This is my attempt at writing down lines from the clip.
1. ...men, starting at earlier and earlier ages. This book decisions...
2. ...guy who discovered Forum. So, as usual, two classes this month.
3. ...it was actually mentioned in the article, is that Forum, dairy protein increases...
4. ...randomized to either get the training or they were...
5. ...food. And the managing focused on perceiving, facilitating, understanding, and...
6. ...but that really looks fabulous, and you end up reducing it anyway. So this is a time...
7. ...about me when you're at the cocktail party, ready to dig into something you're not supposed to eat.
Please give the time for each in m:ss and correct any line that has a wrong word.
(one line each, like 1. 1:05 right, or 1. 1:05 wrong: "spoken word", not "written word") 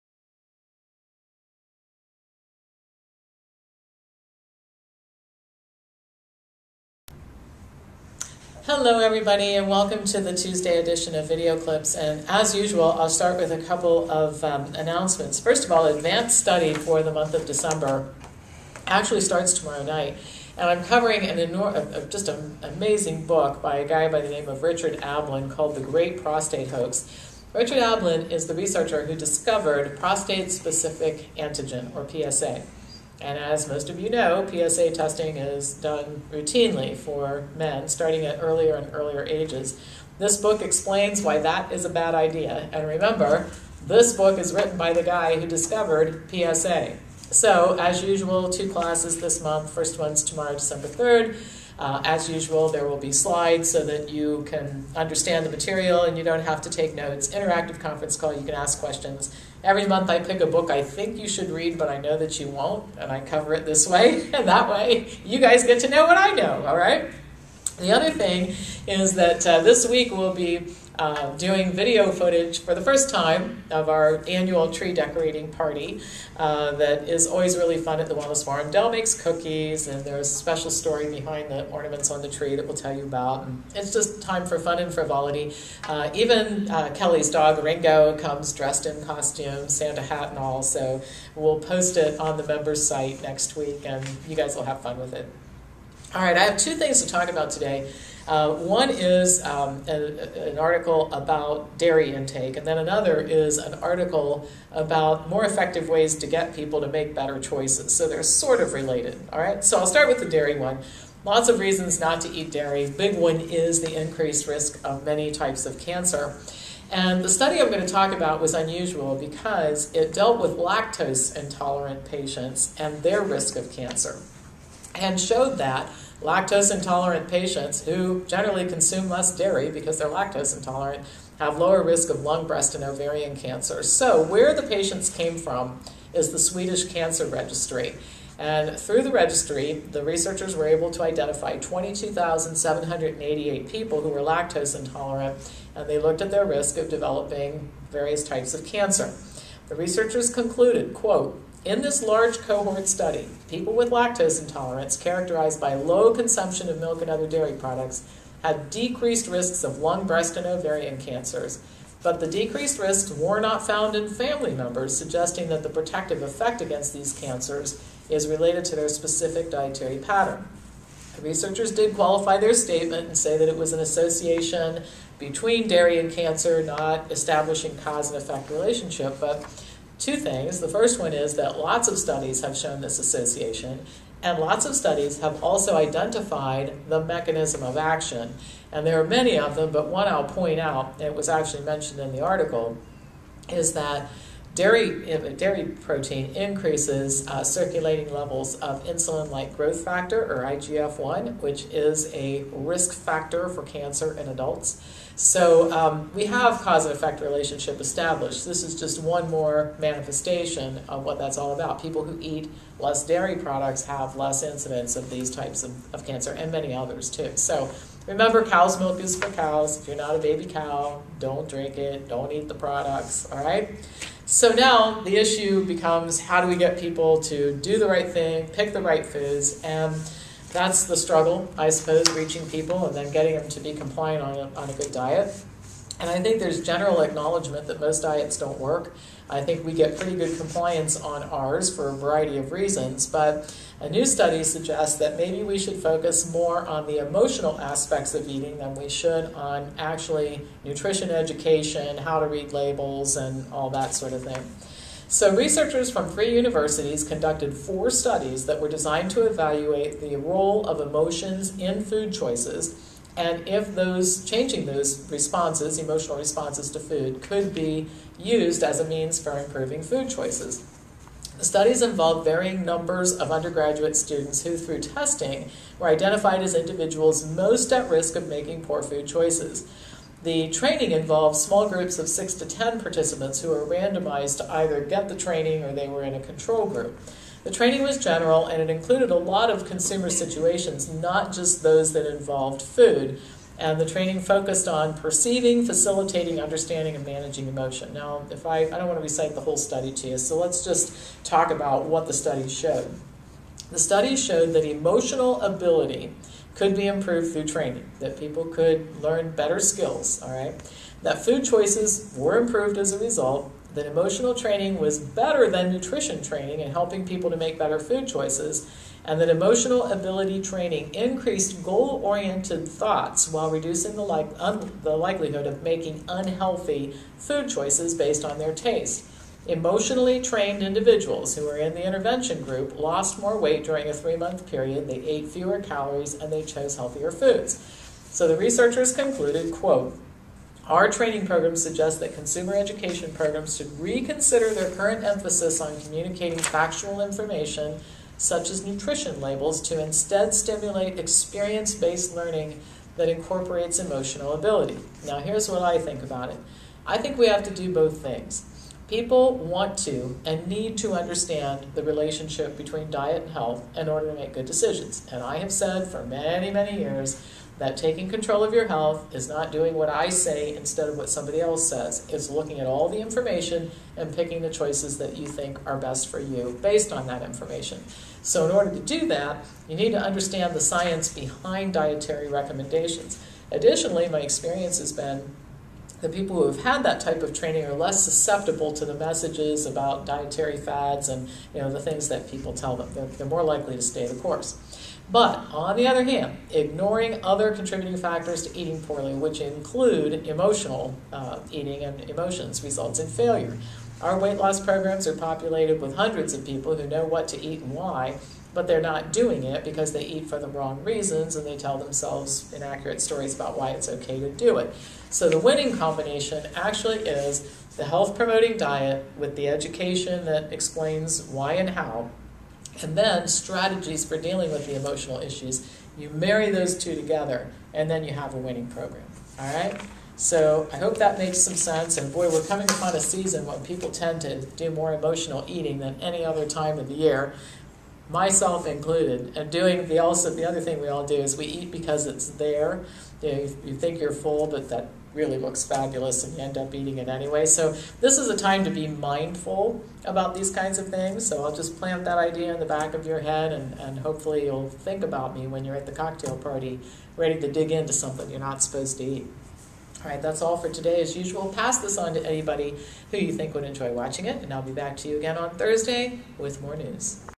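1. 0:37 wrong: "explains", not "decisions"
2. 0:45 wrong: "PSA", not "Forum"
3. 3:11 wrong: "Dairy", not "Forum"
4. 4:43 right
5. 4:52 wrong: "training", not "managing"
6. 7:24 wrong: "eating", not "reducing"
7. 7:35 right.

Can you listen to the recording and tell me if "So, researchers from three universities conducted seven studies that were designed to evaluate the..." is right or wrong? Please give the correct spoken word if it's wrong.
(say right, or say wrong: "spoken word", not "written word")
wrong: "four", not "seven".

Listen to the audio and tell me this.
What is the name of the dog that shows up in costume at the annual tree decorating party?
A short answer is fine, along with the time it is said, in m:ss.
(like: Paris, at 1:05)
Ringo, at 1:27.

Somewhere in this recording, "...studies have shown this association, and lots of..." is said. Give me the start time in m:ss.
3:01.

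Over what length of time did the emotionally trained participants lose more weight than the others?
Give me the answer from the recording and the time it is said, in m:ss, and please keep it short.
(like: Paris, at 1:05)
3 months, at 5:33.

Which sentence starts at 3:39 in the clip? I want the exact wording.
If you're not a baby cow, don't drink it, don't eat the products, all right?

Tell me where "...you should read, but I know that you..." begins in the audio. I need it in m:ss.
1:01.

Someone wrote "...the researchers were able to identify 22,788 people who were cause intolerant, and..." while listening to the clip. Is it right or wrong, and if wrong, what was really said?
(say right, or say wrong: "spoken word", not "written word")
wrong: "lactose", not "cause".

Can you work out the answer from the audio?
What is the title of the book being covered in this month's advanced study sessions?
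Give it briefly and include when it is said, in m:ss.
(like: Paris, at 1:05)
The Great Prostate Hoax, at 0:25.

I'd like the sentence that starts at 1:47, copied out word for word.
So they're sort of related, all right?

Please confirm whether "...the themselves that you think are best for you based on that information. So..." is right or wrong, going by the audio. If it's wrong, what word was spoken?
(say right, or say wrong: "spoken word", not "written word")
wrong: "choices", not "themselves".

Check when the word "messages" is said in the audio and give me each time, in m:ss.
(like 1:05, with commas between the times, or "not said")
6:28.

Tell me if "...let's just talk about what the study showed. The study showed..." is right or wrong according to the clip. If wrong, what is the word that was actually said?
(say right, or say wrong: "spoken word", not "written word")
right.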